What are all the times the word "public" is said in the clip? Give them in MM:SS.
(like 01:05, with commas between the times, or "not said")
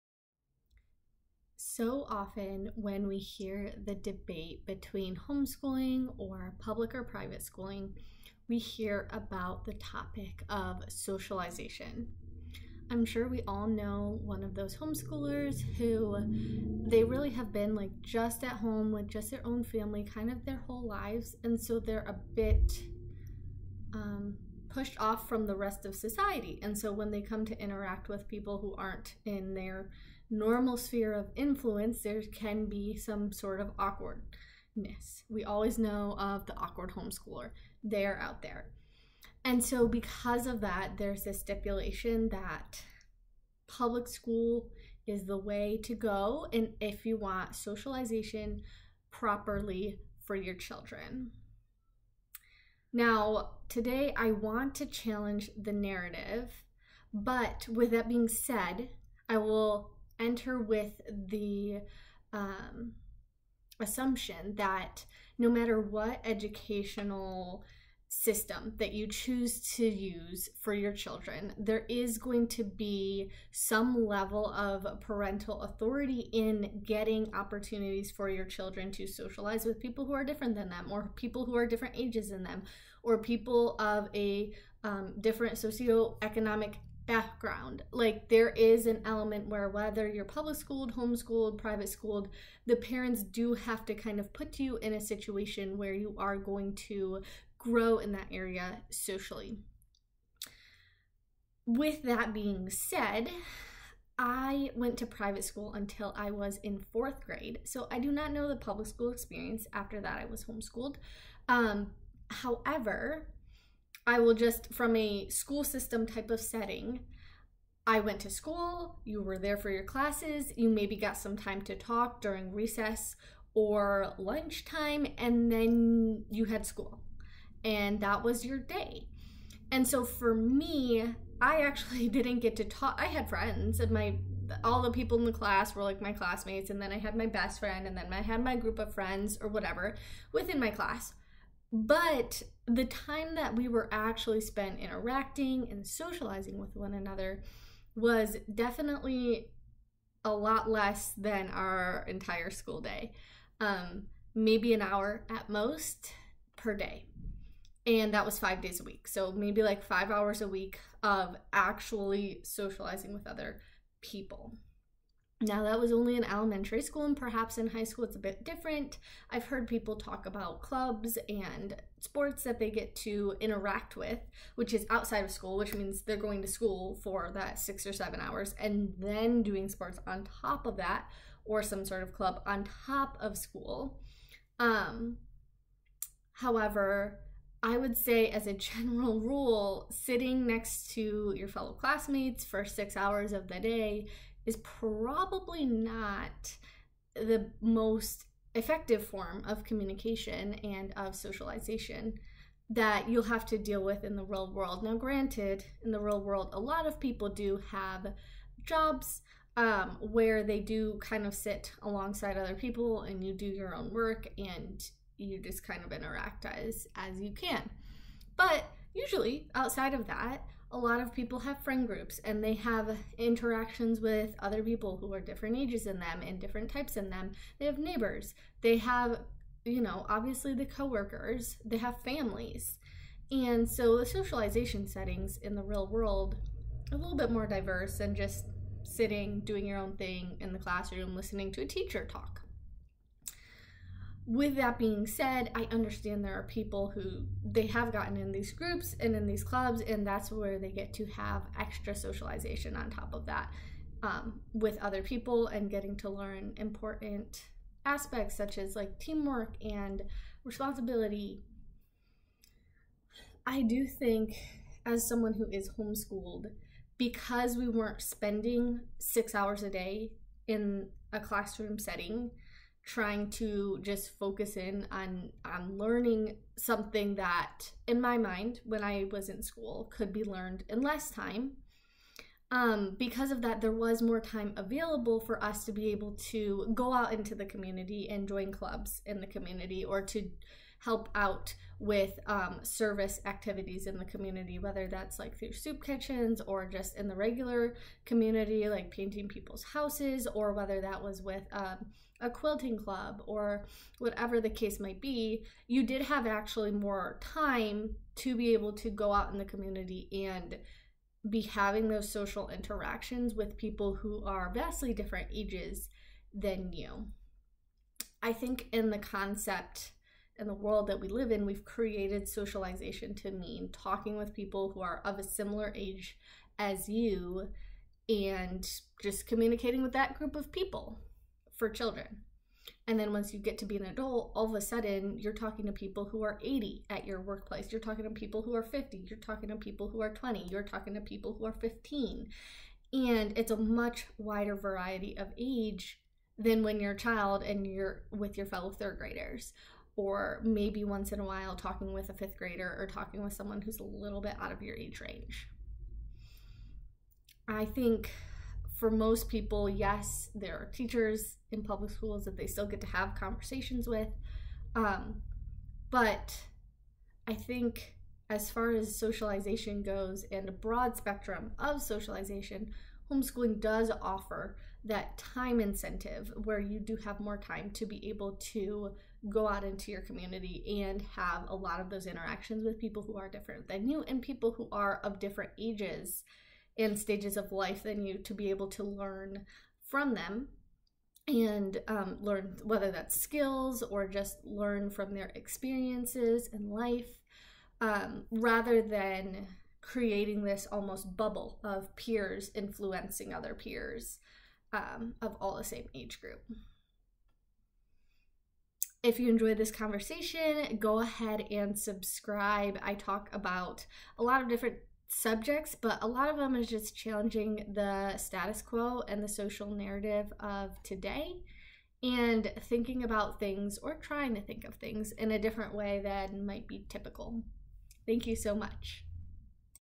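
00:06, 00:43, 01:30, 01:48, 06:01.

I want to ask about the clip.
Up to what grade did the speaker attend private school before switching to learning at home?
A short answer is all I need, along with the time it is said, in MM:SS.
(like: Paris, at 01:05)
4th grade, at 01:46.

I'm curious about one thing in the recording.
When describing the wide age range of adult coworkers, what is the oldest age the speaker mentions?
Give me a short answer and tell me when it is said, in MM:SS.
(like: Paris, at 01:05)
80, at 05:36.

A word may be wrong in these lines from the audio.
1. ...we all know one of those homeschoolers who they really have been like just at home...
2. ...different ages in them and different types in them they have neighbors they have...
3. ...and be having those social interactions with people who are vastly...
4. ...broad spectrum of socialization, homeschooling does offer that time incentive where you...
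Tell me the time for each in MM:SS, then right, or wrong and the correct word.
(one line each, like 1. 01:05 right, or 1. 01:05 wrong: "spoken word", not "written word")
1. 00:13 right
2. 03:45 right
3. 05:10 right
4. 06:10 right.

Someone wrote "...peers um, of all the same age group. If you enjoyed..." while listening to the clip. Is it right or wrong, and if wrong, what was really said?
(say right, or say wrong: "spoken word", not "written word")
right.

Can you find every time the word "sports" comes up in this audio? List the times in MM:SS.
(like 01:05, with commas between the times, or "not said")
02:51, 02:59.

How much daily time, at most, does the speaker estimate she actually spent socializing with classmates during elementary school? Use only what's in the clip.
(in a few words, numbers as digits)
an hour.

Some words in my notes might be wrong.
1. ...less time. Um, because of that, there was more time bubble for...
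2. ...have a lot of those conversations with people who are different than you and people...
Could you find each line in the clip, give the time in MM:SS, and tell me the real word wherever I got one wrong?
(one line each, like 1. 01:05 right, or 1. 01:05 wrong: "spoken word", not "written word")
1. 04:40 wrong: "available", not "bubble"
2. 06:21 wrong: "interactions", not "conversations".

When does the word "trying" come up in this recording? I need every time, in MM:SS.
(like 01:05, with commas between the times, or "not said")
04:32, 07:03.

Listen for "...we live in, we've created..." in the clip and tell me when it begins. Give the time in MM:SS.
05:20.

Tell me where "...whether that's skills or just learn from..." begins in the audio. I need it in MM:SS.
06:32.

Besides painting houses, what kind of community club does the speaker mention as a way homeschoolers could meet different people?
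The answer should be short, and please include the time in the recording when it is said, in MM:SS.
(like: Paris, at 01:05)
quilting club, at 05:02.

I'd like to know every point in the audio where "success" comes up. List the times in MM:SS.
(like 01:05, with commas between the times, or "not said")
not said.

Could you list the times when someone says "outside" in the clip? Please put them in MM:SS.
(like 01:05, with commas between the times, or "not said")
02:54, 03:39.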